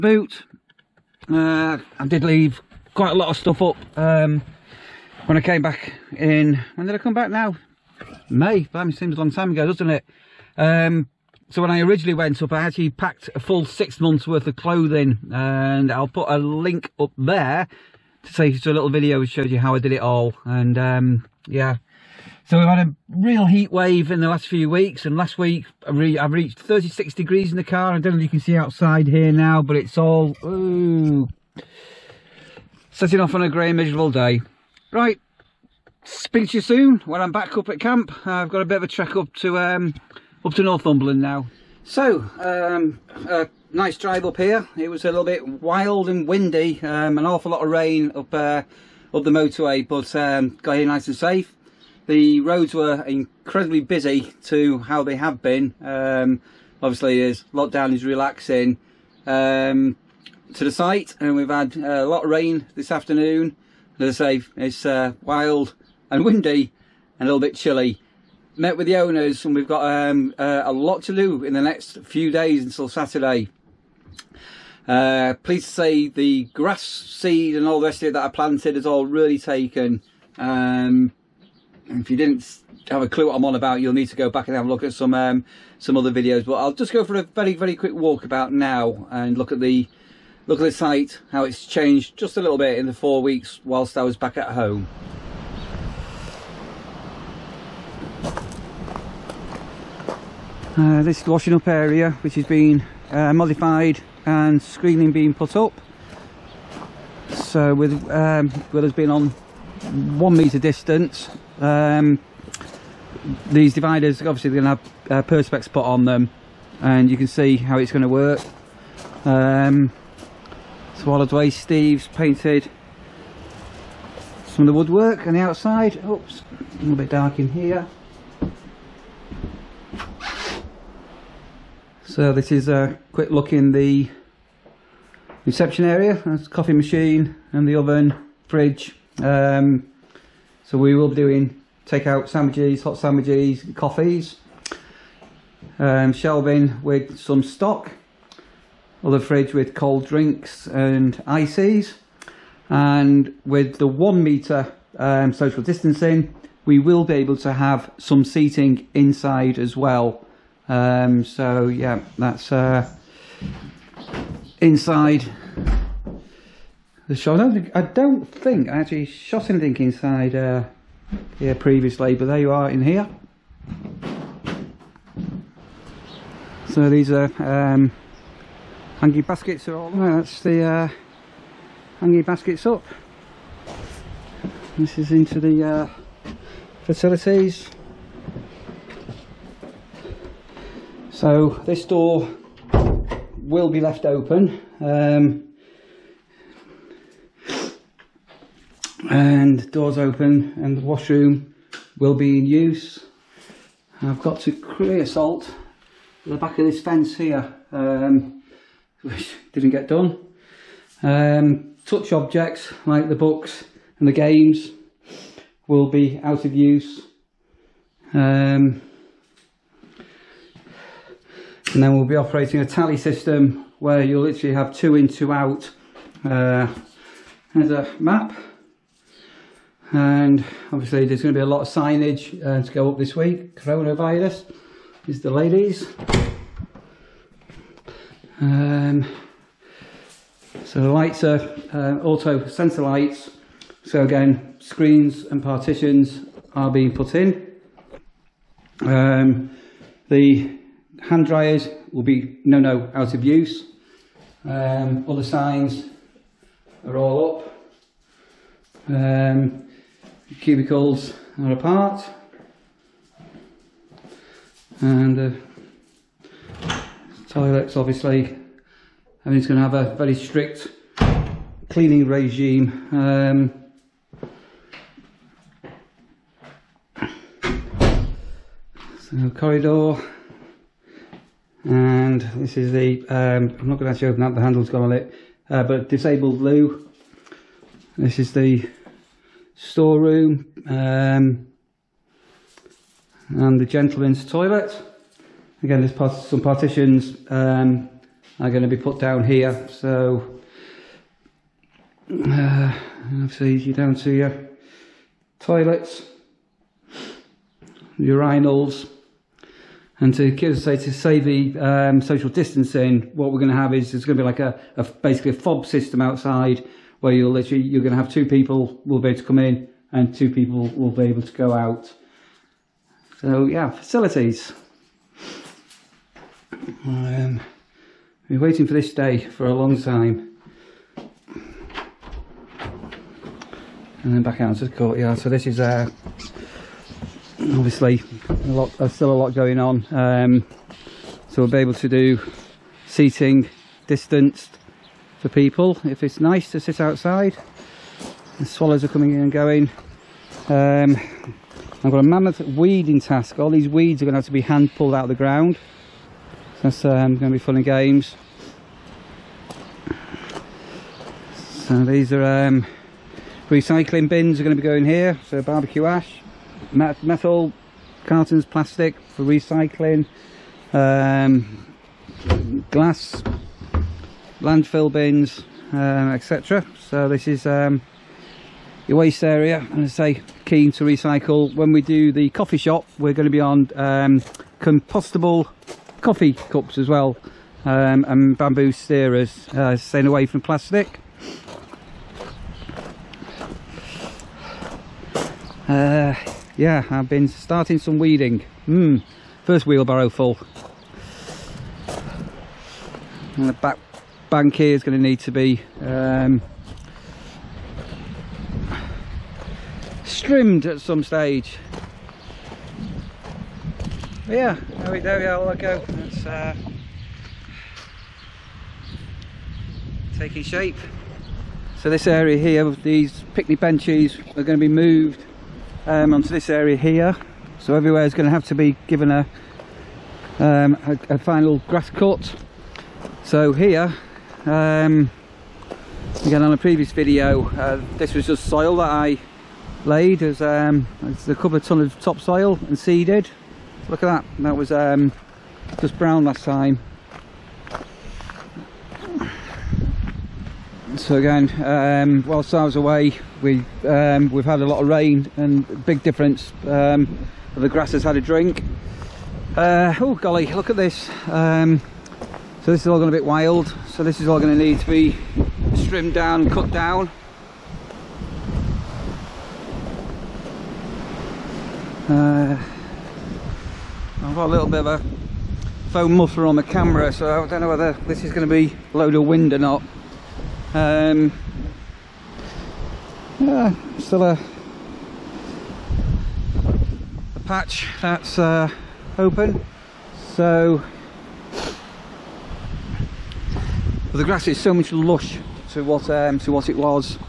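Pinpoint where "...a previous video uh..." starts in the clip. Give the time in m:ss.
7:16.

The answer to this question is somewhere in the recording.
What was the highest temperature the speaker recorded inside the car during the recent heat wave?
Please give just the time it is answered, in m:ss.
0:26.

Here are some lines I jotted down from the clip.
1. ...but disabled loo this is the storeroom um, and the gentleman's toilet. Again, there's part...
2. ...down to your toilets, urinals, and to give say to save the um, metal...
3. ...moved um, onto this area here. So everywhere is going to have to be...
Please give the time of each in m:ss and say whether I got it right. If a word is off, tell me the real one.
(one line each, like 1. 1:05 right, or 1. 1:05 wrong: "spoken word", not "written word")
1. 4:45 right
2. 5:03 wrong: "social", not "metal"
3. 7:04 right.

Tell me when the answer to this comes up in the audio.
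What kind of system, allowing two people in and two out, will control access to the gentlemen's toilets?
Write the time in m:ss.
5:15.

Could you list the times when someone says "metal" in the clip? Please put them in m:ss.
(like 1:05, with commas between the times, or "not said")
6:06.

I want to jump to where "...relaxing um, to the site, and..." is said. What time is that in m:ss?
0:58.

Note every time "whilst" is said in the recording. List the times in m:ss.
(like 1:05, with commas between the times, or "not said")
1:33, 7:32.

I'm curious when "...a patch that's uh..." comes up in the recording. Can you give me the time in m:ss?
8:07.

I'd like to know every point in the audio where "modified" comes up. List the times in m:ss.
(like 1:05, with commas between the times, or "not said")
1:43.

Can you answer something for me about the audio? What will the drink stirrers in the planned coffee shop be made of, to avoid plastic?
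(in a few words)
bamboo.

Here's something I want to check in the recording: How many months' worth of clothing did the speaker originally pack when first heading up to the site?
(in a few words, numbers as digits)
6.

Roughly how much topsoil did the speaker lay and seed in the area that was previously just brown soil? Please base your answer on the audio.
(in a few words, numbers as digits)
a couple of ton.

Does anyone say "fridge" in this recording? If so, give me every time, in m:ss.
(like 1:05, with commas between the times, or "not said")
2:18, 2:29.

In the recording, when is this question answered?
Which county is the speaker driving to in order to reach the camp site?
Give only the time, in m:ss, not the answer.
0:40.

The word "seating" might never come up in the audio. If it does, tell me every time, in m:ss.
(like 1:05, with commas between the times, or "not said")
2:38, 5:42.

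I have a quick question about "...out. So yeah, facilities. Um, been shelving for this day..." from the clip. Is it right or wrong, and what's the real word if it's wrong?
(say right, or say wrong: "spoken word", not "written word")
wrong: "waiting", not "shelving".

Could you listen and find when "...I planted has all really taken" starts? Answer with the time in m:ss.
1:18.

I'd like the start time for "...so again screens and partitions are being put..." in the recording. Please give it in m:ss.
4:03.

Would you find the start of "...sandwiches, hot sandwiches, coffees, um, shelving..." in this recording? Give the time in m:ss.
2:22.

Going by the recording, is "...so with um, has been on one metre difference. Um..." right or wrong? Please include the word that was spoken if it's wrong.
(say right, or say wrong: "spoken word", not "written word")
wrong: "distance", not "difference".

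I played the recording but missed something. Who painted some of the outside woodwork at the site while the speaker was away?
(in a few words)
Steve.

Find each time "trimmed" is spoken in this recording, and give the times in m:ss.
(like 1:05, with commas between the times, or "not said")
6:50, 7:45.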